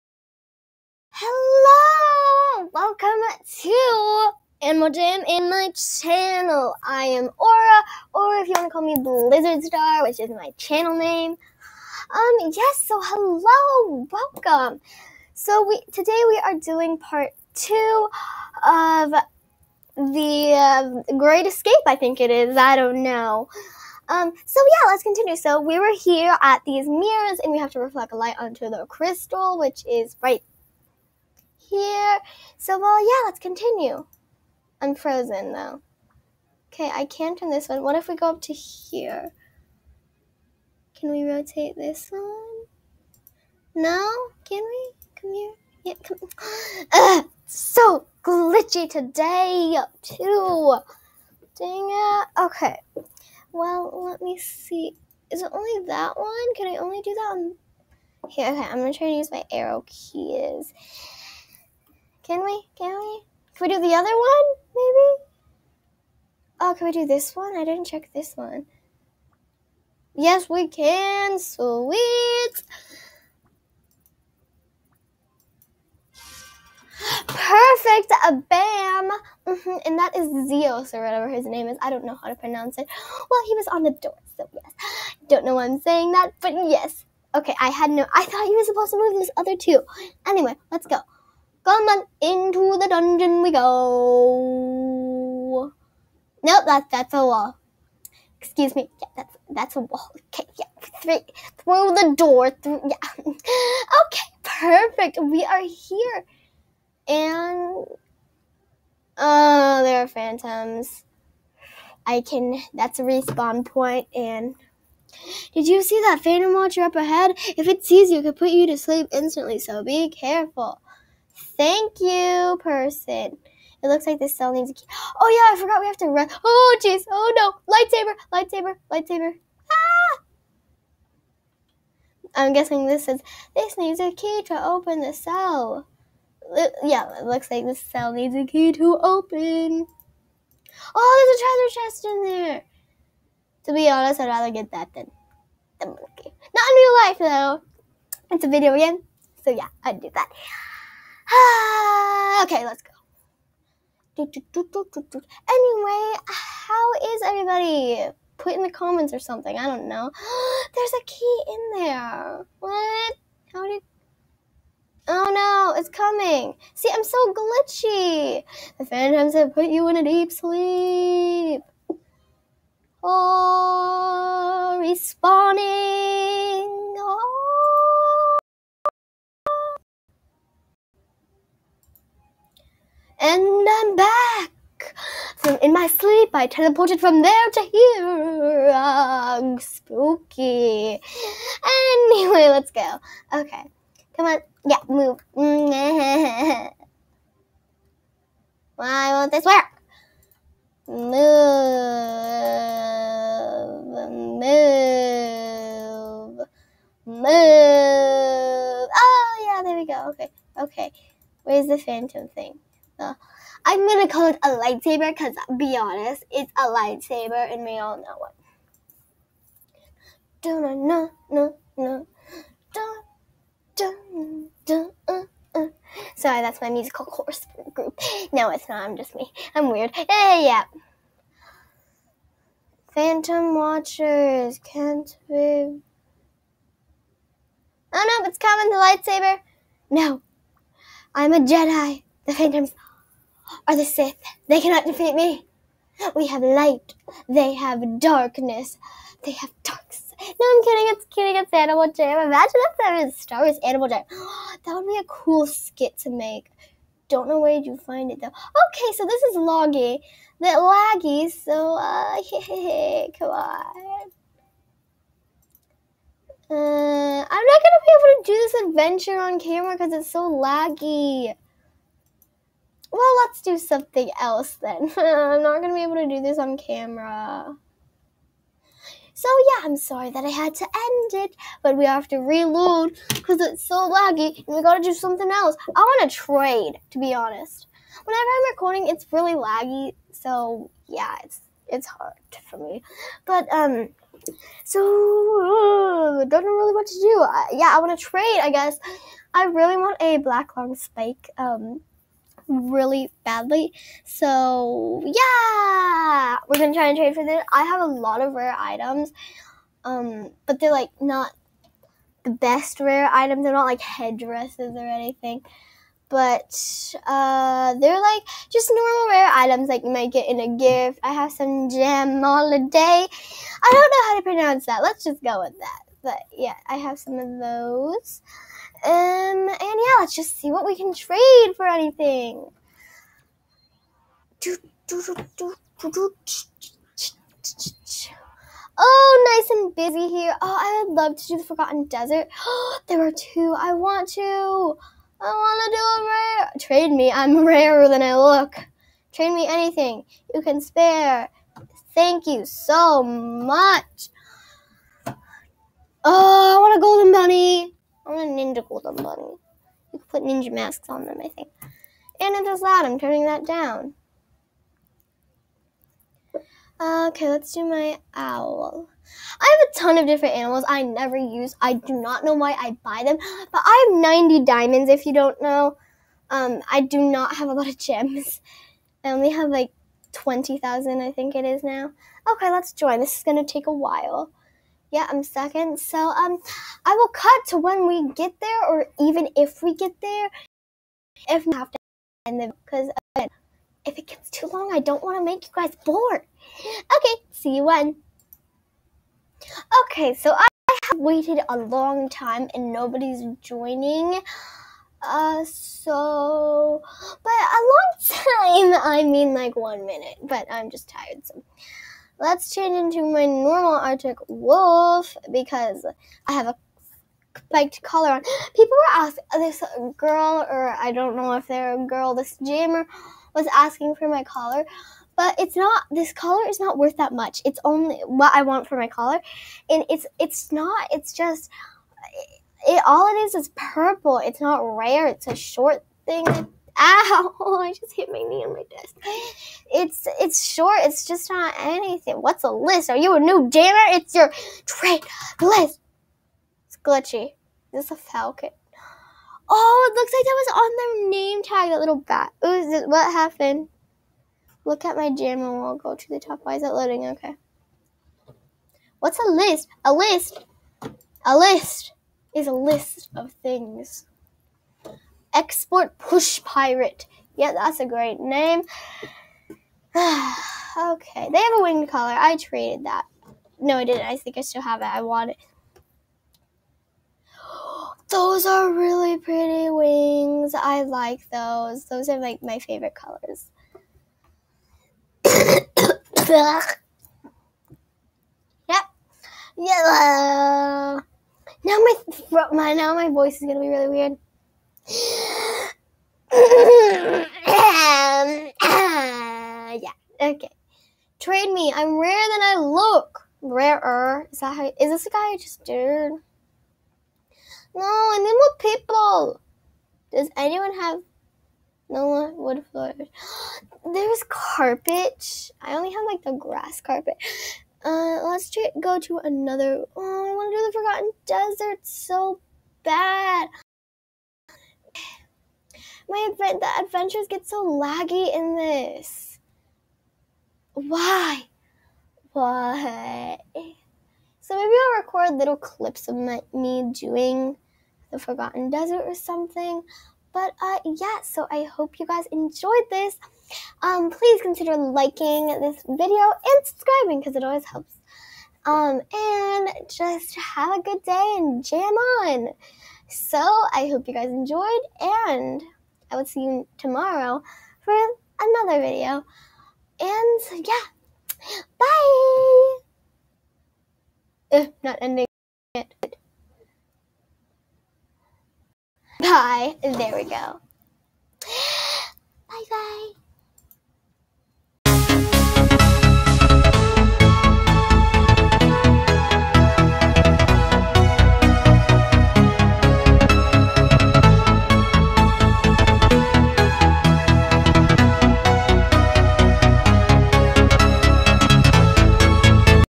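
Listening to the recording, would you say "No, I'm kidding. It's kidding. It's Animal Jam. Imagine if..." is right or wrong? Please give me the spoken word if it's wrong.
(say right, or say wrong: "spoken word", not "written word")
right.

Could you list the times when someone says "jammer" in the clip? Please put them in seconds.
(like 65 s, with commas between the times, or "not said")
422 s, 443 s.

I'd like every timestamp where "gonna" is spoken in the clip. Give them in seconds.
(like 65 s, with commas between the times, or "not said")
58 s, 213 s, 267 s, 306 s, 493 s.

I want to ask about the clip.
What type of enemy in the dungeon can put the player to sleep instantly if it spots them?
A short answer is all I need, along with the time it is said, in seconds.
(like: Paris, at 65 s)
Phantom watcher, at 116 s.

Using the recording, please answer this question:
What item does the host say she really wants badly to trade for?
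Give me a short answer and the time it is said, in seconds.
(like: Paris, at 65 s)
black long spike, at 300 s.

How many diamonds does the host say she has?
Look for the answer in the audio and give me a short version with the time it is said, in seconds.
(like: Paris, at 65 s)
90, at 374 s.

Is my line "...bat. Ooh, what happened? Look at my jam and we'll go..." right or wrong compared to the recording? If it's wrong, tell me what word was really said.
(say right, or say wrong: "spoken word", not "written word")
right.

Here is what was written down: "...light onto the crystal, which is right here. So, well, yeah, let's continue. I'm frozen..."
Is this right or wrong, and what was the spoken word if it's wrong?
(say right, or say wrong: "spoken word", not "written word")
right.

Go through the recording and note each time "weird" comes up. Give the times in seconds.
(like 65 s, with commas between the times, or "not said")
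229 s, 493 s.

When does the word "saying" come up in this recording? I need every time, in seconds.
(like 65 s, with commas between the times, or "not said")
85 s.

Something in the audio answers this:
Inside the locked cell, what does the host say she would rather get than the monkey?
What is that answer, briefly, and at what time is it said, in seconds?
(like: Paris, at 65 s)
treasure chest, at 141 s.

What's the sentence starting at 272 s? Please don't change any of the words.
Well, let's do something else then.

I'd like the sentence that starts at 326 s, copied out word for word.
But yeah, I have some of those.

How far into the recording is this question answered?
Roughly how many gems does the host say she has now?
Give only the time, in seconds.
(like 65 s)
380 s.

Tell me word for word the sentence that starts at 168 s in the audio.
The phantoms have put you in a deep sleep.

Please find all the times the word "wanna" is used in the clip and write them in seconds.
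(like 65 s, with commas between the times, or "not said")
285 s, 297 s.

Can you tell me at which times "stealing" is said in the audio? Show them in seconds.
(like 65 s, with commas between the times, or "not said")
not said.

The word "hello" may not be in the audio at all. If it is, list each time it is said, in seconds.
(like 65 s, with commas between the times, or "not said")
13 s.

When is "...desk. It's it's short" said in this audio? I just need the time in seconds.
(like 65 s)
438 s.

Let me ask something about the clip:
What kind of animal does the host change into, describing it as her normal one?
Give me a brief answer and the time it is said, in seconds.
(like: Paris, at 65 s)
Arctic wolf, at 413 s.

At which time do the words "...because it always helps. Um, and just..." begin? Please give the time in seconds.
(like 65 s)
547 s.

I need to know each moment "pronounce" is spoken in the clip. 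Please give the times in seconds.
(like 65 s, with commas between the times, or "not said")
82 s, 324 s.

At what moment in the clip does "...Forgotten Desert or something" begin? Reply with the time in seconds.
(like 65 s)
538 s.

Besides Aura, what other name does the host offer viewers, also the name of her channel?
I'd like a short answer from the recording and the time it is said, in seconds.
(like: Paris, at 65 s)
Blizzard Star, at 8 s.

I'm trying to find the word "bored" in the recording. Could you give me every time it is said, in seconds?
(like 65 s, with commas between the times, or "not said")
395 s.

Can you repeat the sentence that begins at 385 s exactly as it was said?
So um, I will cut to when we get there, or even if we get there.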